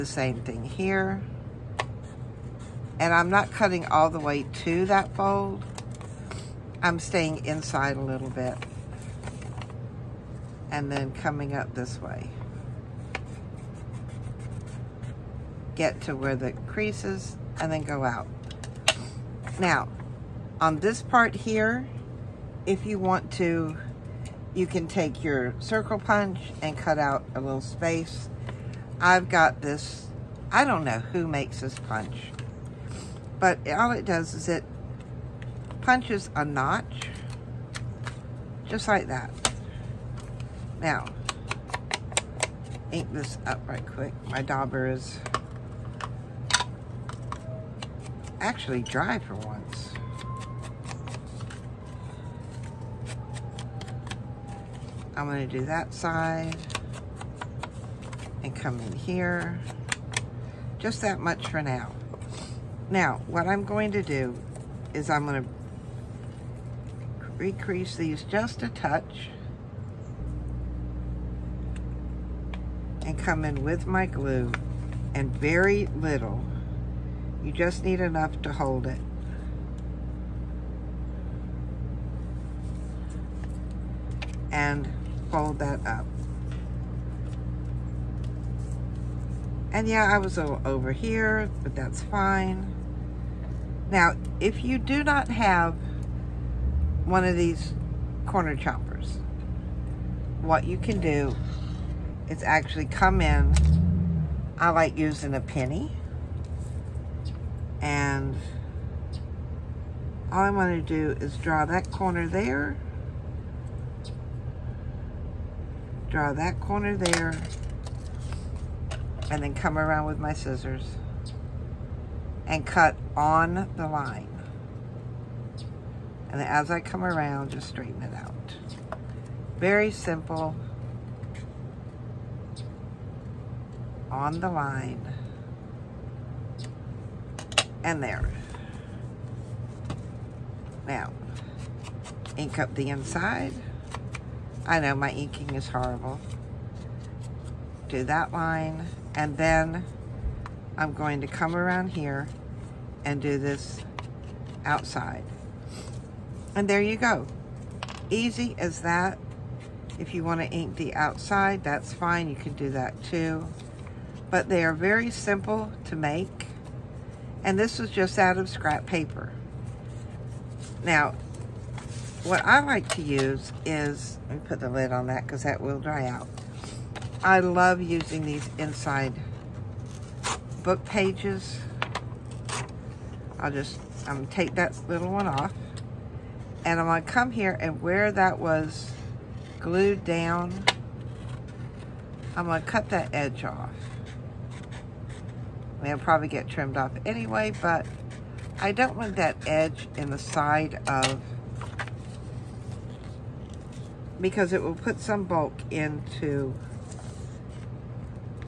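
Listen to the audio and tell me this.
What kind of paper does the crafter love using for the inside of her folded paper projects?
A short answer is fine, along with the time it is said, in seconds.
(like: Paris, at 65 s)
Book pages, at 180 s.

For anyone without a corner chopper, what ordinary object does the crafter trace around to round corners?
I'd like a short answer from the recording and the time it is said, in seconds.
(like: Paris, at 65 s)
A penny, at 105 s.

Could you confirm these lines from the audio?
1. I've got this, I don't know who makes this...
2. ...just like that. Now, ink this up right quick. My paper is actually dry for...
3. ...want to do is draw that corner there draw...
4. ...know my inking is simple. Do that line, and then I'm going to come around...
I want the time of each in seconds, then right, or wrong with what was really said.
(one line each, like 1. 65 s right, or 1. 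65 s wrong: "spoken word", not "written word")
1. 29 s right
2. 38 s wrong: "dauber", not "paper"
3. 110 s right
4. 144 s wrong: "horrible", not "simple".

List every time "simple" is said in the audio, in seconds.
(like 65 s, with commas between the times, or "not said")
129 s, 165 s.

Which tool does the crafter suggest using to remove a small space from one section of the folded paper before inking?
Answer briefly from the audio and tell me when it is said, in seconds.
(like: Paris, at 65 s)
Circle punch, at 25 s.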